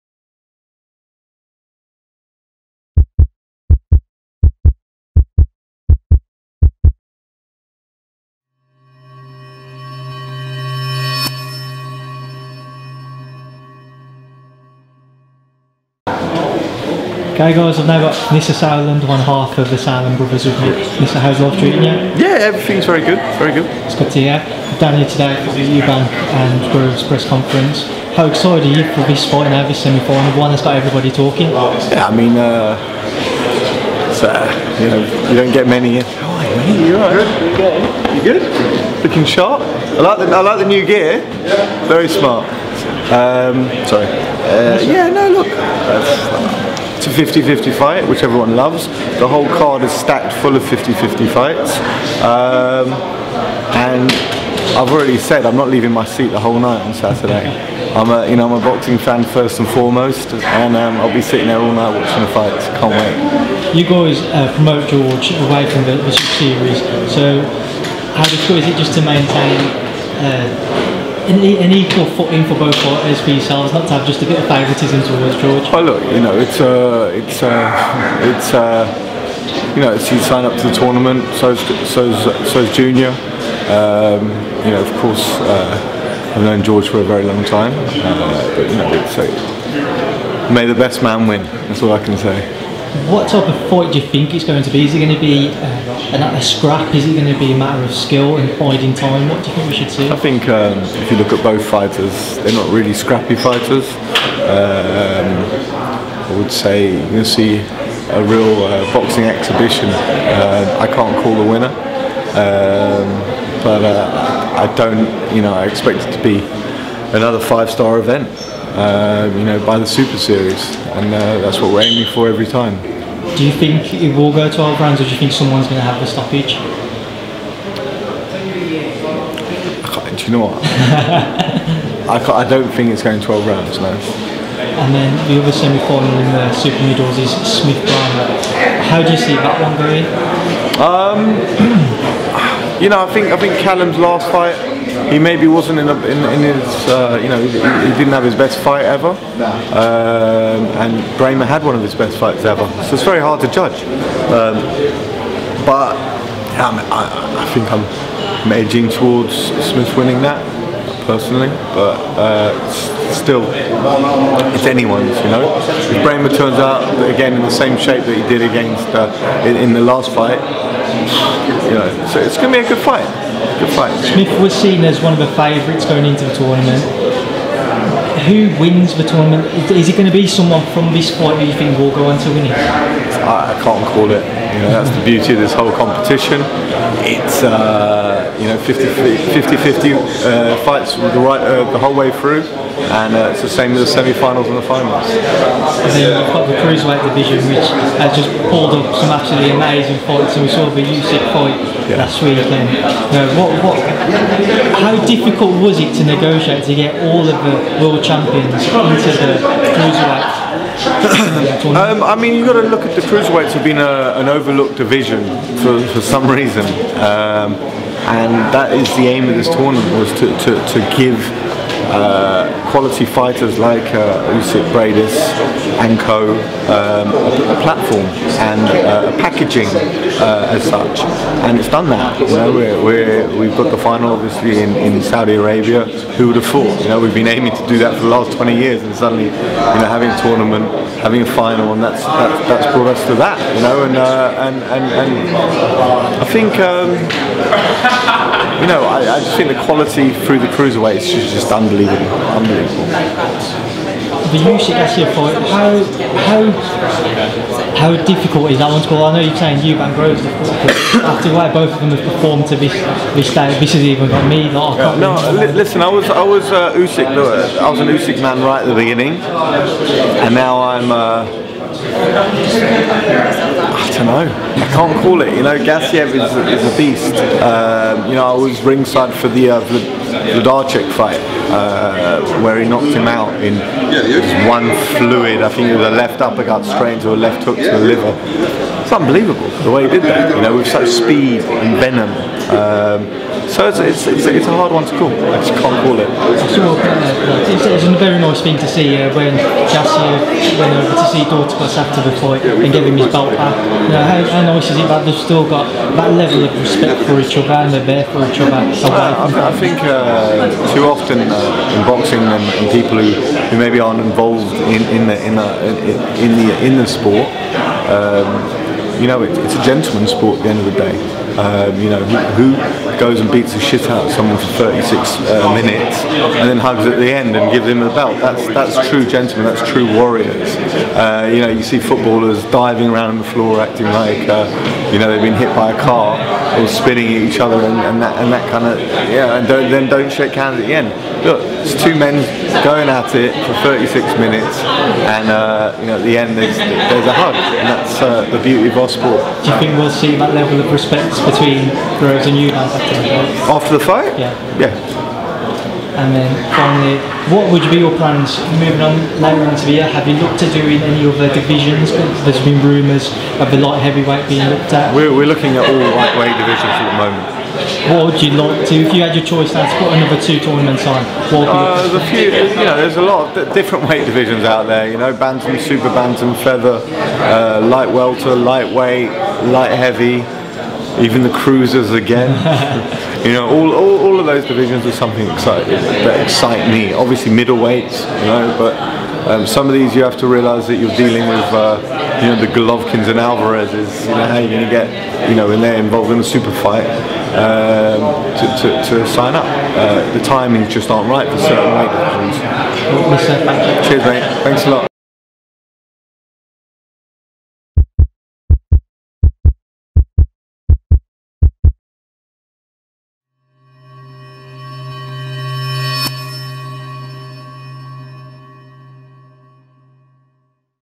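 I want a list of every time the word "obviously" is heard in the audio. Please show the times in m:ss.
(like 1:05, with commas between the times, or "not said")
3:54, 6:26.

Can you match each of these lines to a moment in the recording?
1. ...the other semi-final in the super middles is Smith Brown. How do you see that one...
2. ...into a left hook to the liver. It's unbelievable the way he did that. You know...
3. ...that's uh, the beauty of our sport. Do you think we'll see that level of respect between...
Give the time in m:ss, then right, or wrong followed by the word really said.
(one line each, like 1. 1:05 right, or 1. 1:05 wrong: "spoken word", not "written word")
1. 2:15 right
2. 4:46 right
3. 5:47 right.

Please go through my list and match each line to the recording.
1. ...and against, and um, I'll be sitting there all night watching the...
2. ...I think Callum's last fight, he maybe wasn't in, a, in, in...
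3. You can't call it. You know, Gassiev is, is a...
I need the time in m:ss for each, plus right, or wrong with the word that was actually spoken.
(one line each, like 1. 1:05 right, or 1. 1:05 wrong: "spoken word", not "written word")
1. 0:59 wrong: "foremost", not "against"
2. 2:23 right
3. 4:34 right.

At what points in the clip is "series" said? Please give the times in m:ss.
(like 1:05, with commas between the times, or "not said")
1:06, 2:00.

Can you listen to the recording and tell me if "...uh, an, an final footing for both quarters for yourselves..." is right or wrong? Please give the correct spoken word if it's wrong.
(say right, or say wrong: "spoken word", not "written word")
wrong: "equal", not "final".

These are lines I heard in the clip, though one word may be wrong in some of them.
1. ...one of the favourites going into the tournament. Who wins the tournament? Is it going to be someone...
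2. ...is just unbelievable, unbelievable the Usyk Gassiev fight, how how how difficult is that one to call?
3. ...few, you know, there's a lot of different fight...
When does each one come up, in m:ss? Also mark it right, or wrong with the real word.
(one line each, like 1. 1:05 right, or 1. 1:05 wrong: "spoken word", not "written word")
1. 2:55 right
2. 4:11 right
3. 6:12 wrong: "weight", not "fight".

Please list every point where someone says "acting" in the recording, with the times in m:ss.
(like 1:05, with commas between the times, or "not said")
5:33.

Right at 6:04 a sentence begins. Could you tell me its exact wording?
We're, we're looking at all lightweight divisions at the moment.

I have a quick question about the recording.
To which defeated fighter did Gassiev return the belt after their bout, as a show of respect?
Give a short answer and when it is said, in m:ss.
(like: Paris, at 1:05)
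Dorticos, at 5:01.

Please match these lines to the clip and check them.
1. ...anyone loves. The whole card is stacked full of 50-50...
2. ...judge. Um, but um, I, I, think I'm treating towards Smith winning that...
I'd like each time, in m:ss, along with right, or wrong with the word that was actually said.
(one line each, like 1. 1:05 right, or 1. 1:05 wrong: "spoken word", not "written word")
1. 0:48 wrong: "everyone", not "anyone"
2. 2:33 wrong: "edging", not "treating".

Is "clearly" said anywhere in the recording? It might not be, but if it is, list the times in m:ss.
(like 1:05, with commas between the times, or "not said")
not said.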